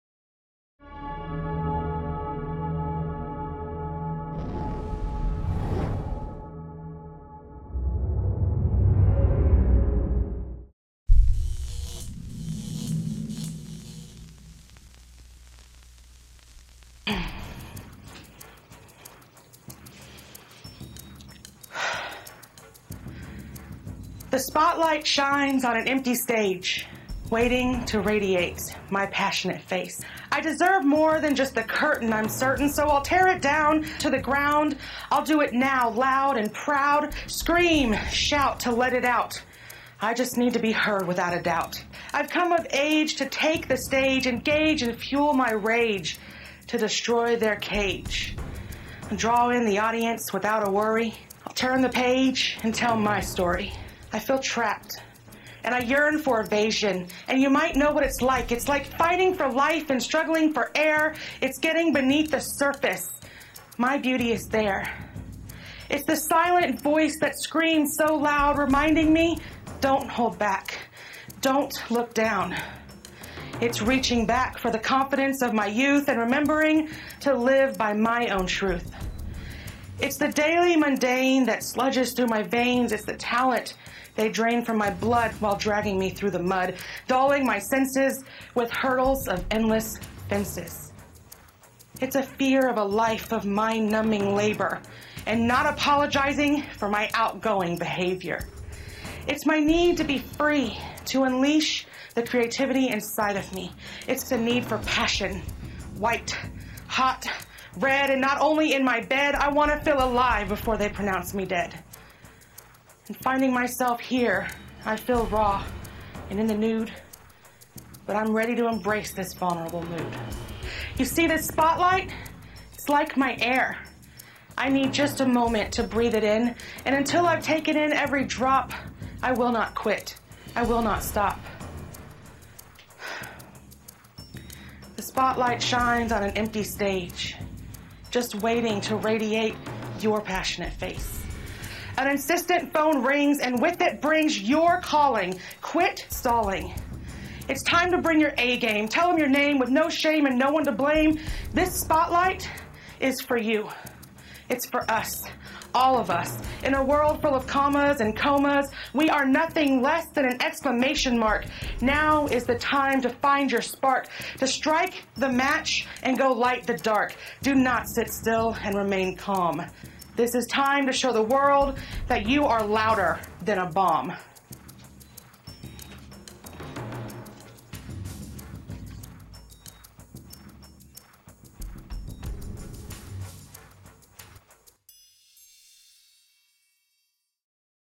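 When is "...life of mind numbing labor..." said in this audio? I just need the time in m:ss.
1:32.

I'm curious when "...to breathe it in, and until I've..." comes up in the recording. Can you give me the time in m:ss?
2:05.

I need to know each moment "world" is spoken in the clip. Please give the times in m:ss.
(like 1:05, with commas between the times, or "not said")
2:36, 2:51.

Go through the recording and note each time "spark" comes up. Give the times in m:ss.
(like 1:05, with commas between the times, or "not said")
2:43.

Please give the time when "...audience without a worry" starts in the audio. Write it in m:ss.
0:49.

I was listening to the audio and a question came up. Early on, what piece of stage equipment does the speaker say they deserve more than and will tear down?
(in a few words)
the curtain.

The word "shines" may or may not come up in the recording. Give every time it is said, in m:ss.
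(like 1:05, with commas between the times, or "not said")
0:25, 2:15.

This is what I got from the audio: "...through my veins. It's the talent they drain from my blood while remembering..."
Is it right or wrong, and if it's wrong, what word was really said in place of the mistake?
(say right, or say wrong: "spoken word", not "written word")
wrong: "dragging", not "remembering".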